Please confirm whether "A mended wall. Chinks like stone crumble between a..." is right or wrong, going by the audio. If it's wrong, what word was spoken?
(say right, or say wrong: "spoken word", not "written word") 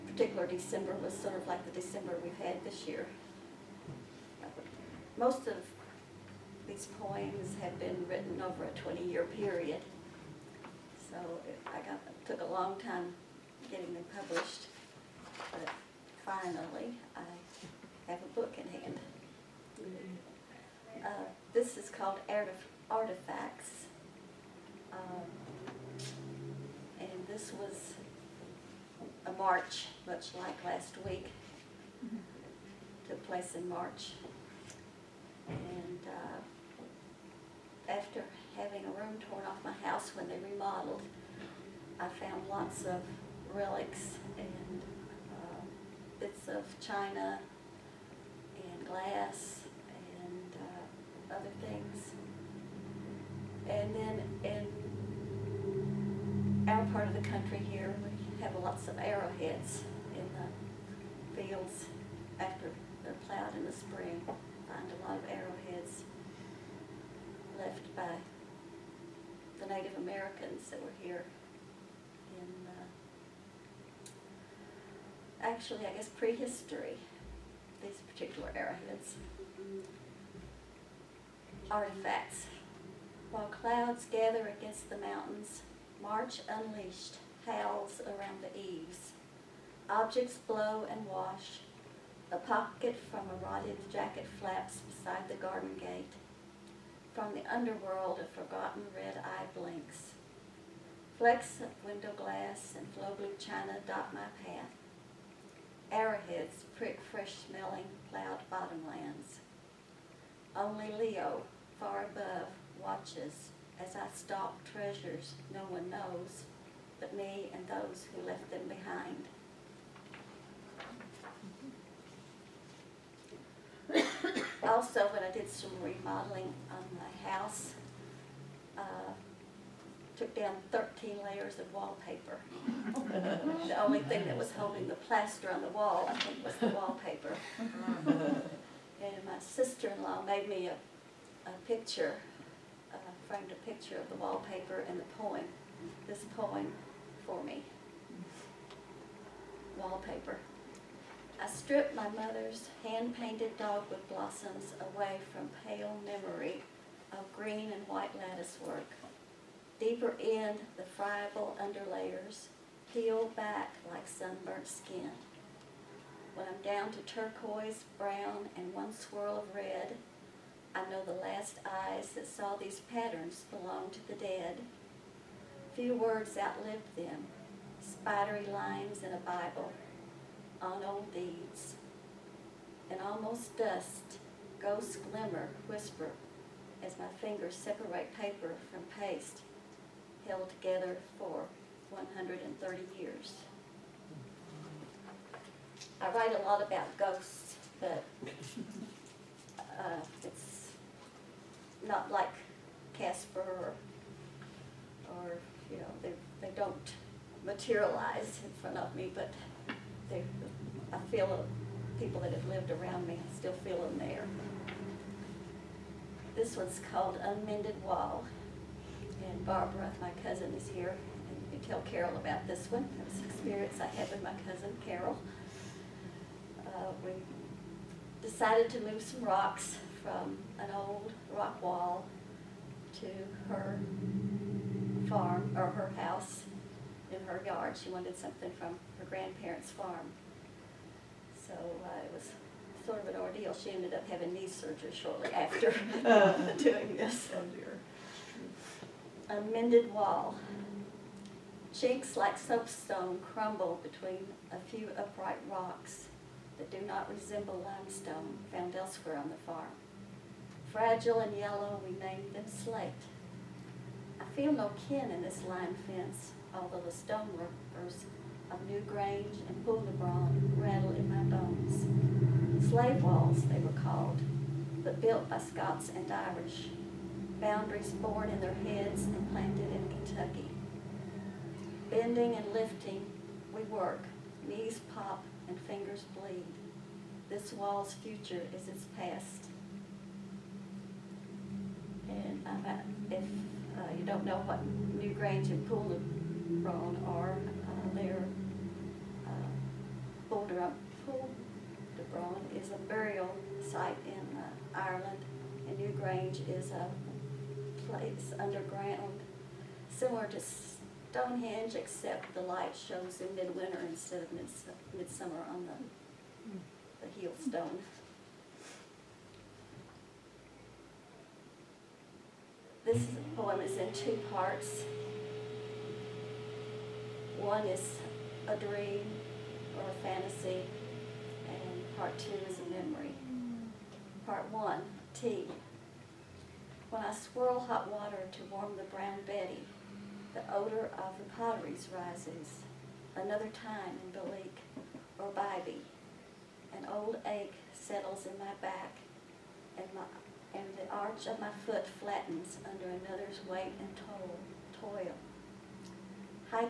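wrong: "soapstone", not "stone".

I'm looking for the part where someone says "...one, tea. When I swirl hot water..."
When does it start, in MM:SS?
05:34.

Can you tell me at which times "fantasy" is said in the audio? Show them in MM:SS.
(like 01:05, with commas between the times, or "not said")
05:30.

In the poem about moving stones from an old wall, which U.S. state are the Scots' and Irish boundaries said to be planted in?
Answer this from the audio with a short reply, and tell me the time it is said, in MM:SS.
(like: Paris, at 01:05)
Kentucky, at 04:39.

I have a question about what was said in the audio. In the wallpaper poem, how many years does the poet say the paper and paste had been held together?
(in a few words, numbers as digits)
130 years.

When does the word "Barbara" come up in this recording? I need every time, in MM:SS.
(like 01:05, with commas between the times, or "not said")
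03:39.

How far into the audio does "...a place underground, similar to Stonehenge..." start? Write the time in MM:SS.
05:06.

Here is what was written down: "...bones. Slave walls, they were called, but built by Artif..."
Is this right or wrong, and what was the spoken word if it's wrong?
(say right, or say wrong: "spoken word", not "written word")
wrong: "Scots", not "Artif".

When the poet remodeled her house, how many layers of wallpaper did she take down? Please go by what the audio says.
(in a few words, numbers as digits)
13.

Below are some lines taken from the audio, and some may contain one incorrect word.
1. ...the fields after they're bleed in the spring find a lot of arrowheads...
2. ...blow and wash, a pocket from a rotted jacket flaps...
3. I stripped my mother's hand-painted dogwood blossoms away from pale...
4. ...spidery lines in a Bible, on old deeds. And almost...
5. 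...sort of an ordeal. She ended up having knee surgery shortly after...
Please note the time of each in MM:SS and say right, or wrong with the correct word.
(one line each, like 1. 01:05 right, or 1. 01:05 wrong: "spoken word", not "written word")
1. 01:00 wrong: "plowed", not "bleed"
2. 01:30 right
3. 02:31 right
4. 02:57 right
5. 04:02 right.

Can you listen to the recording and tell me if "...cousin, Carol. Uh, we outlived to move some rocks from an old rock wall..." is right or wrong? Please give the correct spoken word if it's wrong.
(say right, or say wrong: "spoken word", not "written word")
wrong: "decided", not "outlived".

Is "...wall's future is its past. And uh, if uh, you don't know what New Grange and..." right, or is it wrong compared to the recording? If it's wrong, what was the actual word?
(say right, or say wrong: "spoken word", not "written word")
right.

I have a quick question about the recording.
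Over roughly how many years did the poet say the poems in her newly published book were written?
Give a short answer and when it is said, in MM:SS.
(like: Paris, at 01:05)
20 years, at 00:08.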